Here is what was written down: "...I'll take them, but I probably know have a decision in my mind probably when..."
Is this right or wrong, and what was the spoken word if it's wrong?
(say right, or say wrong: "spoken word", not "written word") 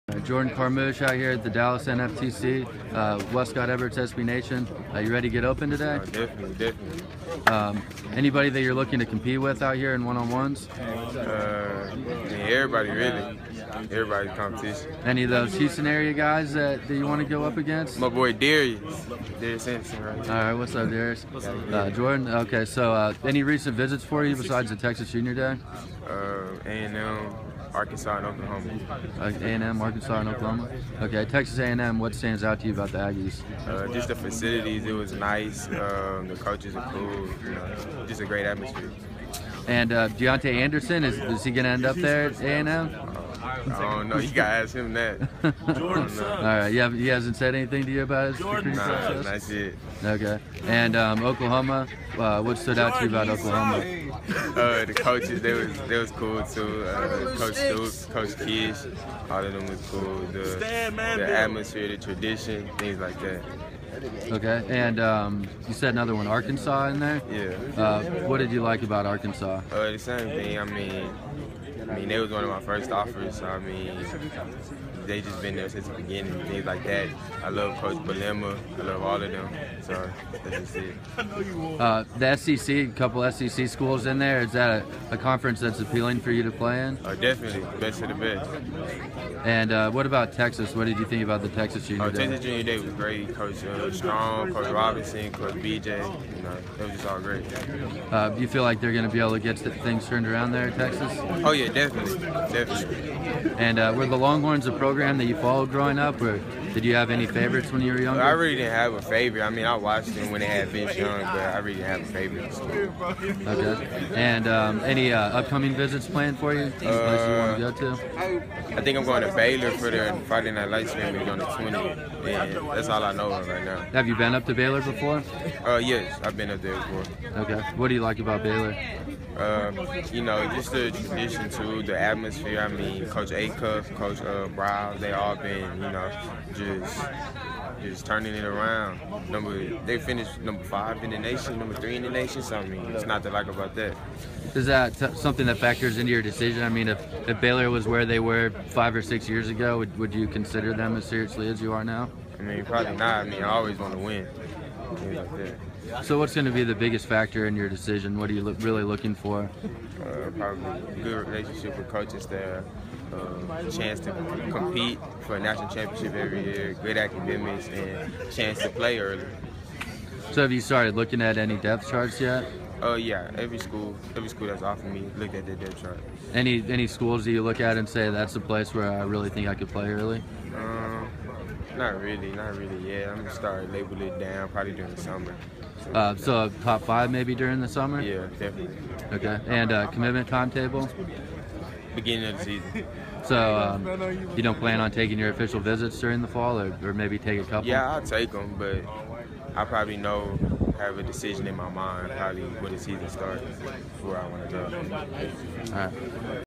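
right.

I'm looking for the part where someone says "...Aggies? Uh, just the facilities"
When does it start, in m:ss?
0:32.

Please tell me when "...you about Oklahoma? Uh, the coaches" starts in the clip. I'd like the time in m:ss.
0:53.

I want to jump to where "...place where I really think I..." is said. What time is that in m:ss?
2:58.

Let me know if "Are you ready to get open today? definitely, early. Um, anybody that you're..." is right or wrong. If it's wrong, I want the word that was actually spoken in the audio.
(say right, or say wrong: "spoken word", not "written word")
wrong: "definitely", not "early".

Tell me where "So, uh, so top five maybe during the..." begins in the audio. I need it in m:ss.
3:05.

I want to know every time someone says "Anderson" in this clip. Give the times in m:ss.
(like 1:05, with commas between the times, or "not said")
0:19, 0:40.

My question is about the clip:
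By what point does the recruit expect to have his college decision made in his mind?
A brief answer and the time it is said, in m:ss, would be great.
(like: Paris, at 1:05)
Beginning of the season, at 3:11.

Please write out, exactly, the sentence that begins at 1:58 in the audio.
Uh, I think I'm going to Baylor for the Friday Night Lights game on the 20th.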